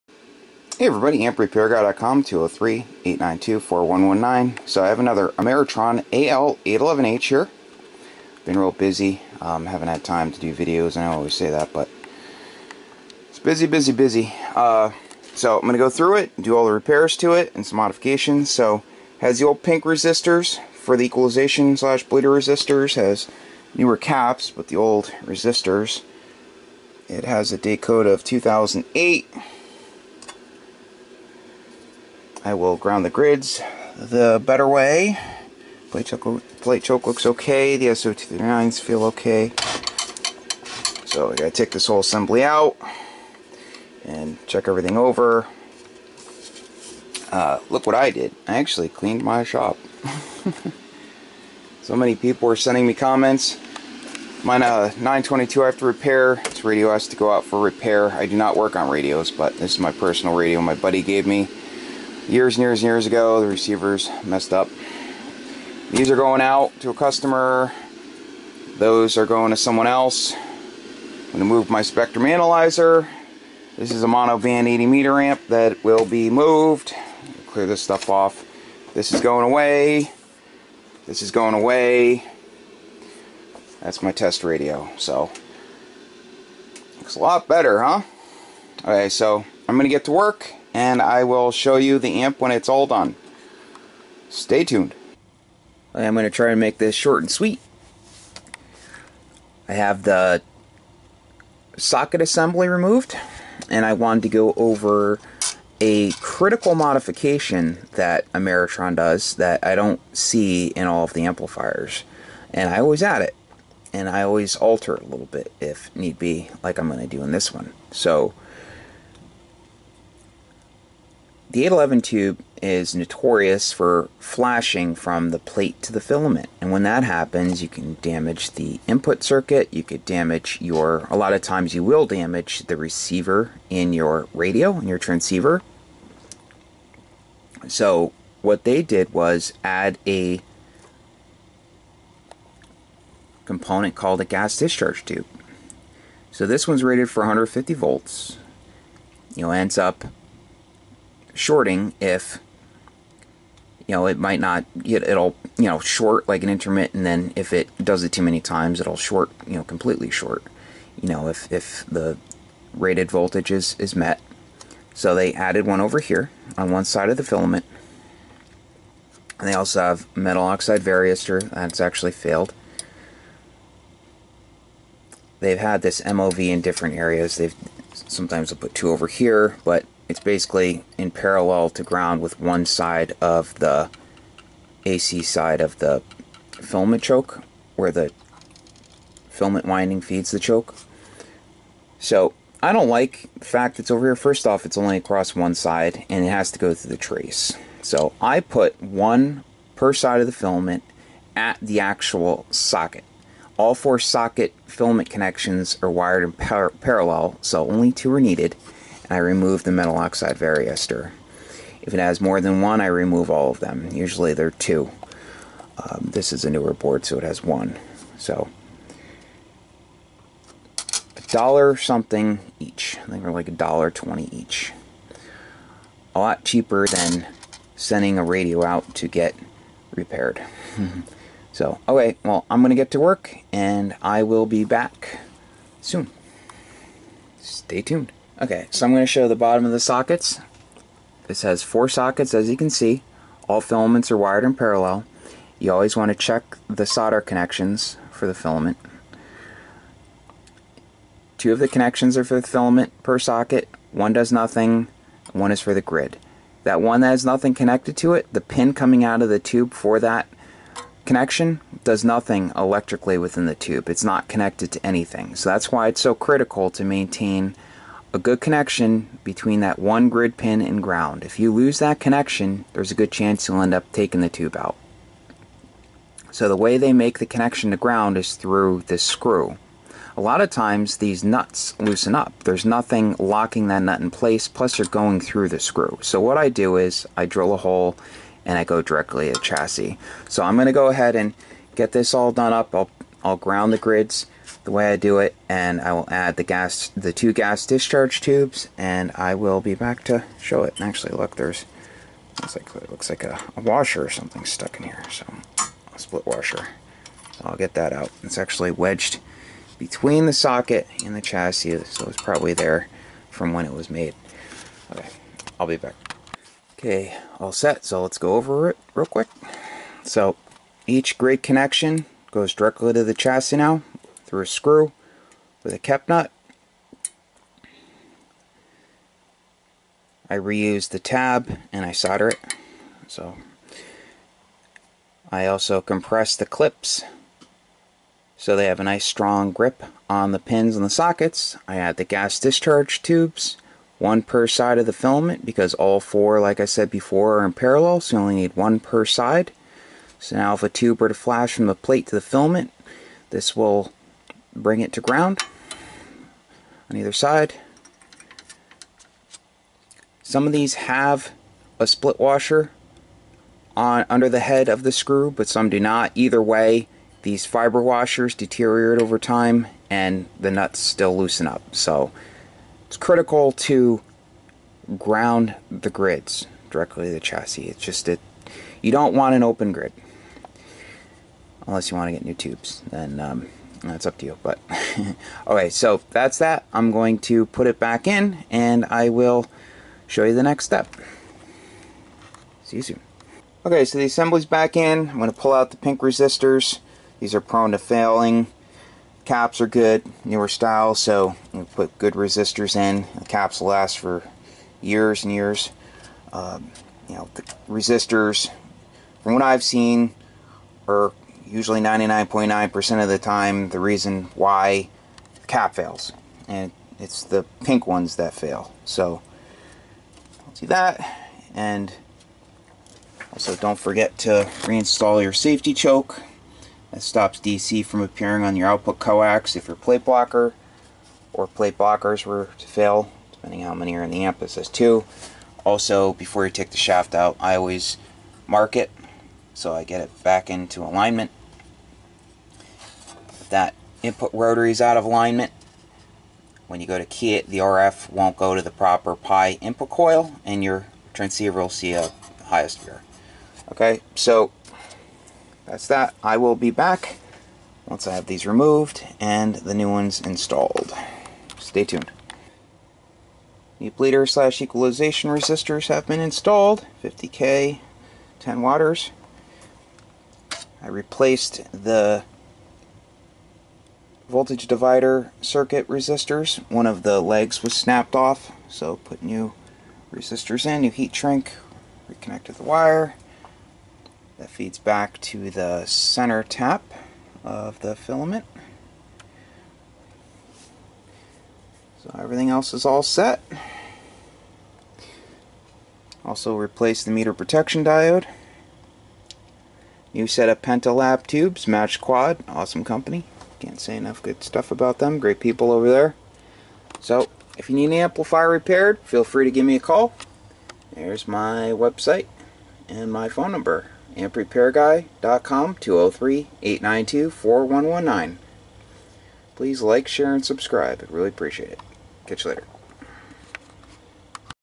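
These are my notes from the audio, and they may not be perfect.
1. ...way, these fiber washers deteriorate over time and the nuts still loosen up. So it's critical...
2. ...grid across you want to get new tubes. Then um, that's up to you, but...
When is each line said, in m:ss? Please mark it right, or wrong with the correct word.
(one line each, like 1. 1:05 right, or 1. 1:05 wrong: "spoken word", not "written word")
1. 6:06 right
2. 6:19 wrong: "unless", not "across".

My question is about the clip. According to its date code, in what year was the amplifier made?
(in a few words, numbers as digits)
2008.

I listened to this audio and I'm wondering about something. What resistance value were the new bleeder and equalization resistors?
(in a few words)
50K.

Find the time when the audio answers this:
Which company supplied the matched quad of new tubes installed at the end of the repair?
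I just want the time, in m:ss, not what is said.
8:20.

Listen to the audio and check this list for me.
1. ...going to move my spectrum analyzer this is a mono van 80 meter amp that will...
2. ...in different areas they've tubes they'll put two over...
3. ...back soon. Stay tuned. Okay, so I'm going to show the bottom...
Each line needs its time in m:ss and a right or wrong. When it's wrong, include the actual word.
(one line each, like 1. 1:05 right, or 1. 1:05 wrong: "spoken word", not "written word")
1. 1:11 right
2. 2:56 wrong: "sometimes", not "tubes"
3. 3:54 right.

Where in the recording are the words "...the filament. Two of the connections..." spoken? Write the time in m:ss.
4:08.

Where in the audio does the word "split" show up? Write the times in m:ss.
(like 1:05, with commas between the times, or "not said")
5:05, 6:01.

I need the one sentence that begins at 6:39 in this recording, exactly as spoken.
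Caps are good, newer style, so you put good resistors in.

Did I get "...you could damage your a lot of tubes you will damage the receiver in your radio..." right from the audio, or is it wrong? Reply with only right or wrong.
wrong.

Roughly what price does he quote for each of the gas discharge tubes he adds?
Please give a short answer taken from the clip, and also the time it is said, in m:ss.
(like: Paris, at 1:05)
$1.20, at 3:43.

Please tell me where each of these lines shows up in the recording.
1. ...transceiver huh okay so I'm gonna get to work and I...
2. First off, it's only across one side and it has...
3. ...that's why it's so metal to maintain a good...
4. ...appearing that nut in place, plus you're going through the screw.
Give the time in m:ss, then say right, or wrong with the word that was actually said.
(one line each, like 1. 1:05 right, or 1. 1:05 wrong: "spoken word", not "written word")
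1. 1:27 wrong: "better", not "transceiver"
2. 3:14 right
3. 4:25 wrong: "critical", not "metal"
4. 4:43 wrong: "locking", not "appearing".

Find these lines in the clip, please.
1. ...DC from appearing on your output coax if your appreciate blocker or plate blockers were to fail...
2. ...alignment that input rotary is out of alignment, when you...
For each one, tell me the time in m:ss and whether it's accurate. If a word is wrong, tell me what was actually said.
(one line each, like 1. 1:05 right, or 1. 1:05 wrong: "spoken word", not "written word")
1. 7:07 wrong: "plate", not "appreciate"
2. 7:20 right.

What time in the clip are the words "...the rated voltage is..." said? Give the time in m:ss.
2:41.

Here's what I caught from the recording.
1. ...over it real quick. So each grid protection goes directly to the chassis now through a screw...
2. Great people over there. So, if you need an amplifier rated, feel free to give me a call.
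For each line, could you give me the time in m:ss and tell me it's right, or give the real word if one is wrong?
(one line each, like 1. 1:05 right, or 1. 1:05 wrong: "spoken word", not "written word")
1. 5:18 wrong: "connection", not "protection"
2. 8:25 wrong: "repaired", not "rated".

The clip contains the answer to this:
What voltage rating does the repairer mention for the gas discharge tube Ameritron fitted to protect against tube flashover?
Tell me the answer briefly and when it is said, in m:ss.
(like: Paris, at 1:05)
150 volts, at 2:27.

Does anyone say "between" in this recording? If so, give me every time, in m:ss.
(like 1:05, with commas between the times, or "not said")
4:29, 5:09.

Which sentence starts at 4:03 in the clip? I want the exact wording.
All filaments are wired in parallel.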